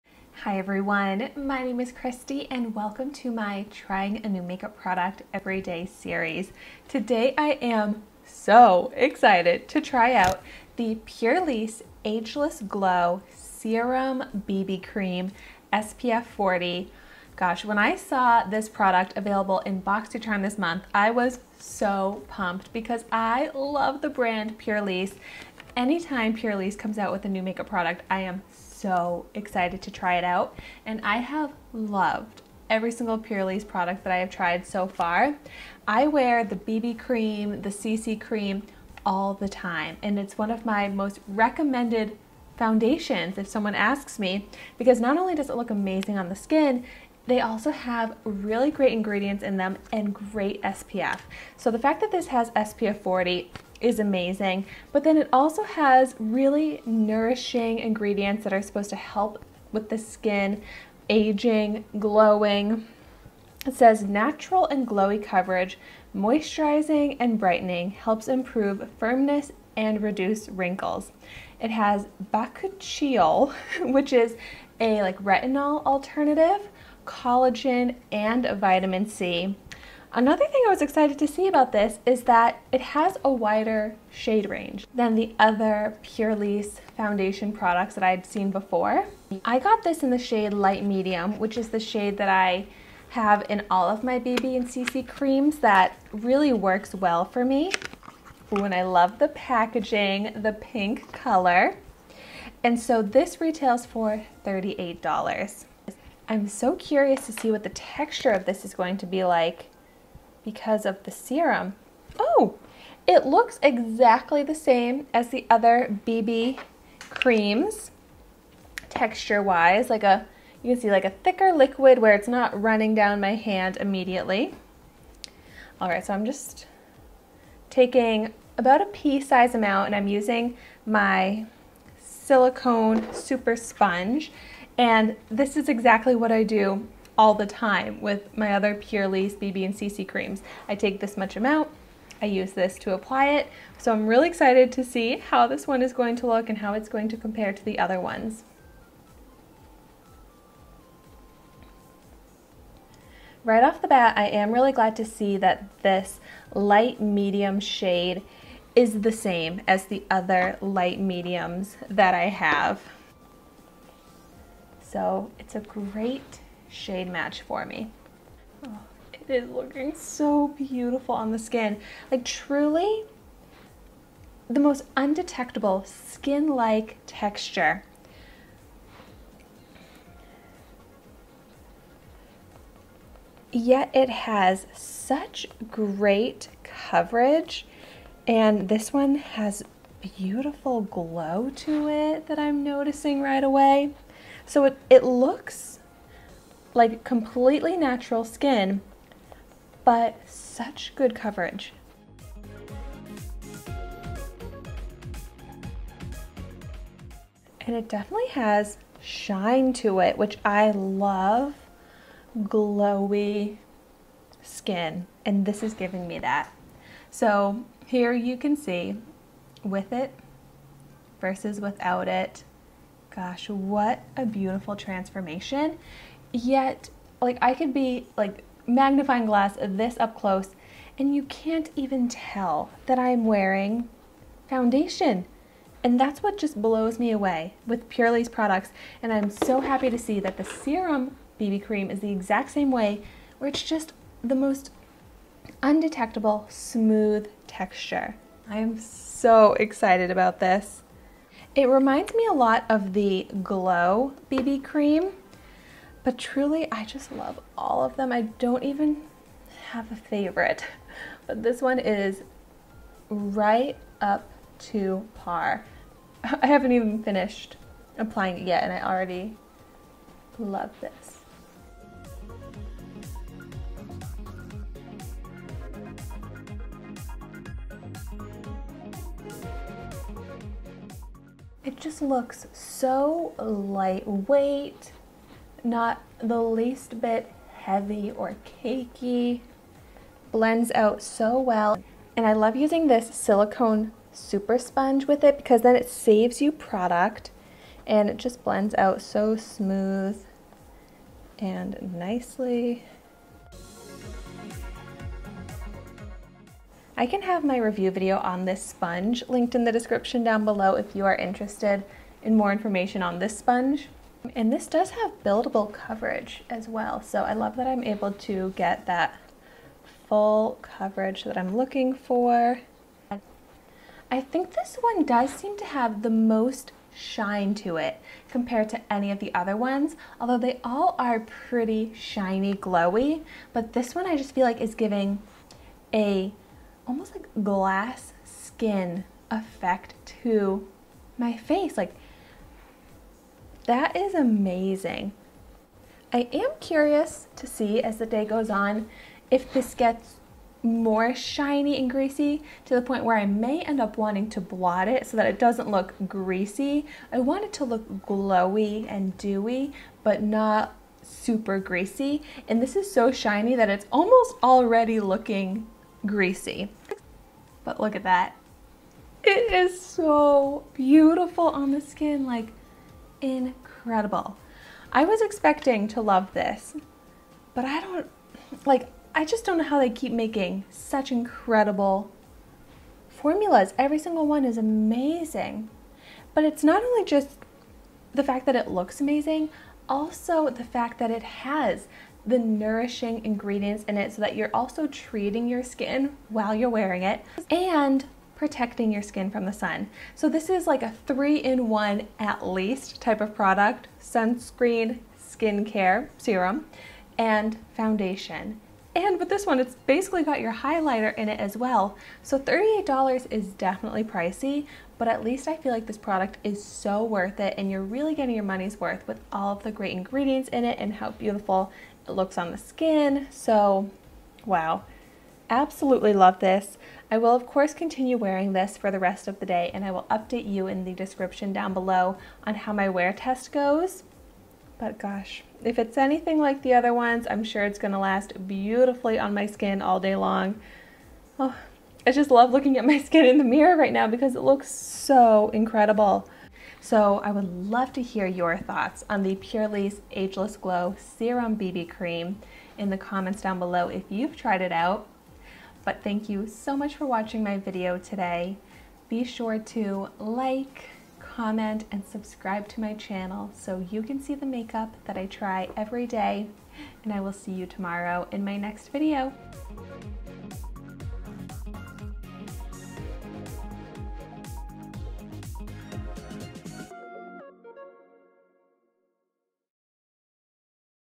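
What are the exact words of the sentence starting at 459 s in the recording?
Be sure to like, comment, and subscribe to my channel so you can see the makeup that I try every day.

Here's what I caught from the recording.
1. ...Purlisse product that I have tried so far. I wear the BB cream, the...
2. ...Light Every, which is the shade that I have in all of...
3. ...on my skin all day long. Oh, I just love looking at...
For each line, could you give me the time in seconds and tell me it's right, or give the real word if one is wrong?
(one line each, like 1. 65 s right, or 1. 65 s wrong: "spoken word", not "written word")
1. 33 s right
2. 90 s wrong: "Medium", not "Every"
3. 439 s right.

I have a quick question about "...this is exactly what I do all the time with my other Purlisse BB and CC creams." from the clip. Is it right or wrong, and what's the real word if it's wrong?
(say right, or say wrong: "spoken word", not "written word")
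right.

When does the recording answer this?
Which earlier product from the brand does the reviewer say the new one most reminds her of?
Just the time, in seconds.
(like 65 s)
253 s.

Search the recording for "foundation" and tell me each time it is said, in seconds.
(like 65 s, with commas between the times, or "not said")
42 s, 86 s, 234 s, 407 s.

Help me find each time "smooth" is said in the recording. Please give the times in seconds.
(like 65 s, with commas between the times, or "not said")
246 s, 299 s.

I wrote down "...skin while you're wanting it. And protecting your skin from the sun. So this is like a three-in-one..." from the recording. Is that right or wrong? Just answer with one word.
wrong.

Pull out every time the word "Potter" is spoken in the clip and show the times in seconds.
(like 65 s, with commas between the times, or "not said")
not said.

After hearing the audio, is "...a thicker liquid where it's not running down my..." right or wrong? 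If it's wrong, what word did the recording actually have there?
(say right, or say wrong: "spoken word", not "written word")
right.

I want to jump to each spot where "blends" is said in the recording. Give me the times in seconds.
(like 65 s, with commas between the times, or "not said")
290 s, 298 s.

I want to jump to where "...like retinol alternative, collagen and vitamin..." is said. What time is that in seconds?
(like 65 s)
75 s.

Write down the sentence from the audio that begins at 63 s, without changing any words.
It says natural and glowy coverage, moisturizing and brightening, helps improve firmness and reduce wrinkles.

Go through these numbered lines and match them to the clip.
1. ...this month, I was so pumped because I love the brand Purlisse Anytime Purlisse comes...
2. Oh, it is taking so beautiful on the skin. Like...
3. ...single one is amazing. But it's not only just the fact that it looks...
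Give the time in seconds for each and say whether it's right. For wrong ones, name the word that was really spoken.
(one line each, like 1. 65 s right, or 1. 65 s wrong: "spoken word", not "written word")
1. 20 s right
2. 168 s wrong: "looking", not "taking"
3. 383 s right.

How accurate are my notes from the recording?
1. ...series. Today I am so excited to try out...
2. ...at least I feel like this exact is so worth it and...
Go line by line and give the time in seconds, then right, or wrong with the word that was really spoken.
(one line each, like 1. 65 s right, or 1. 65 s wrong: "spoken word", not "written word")
1. 5 s right
2. 415 s wrong: "product", not "exact".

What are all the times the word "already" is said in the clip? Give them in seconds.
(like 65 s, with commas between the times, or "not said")
268 s, 364 s.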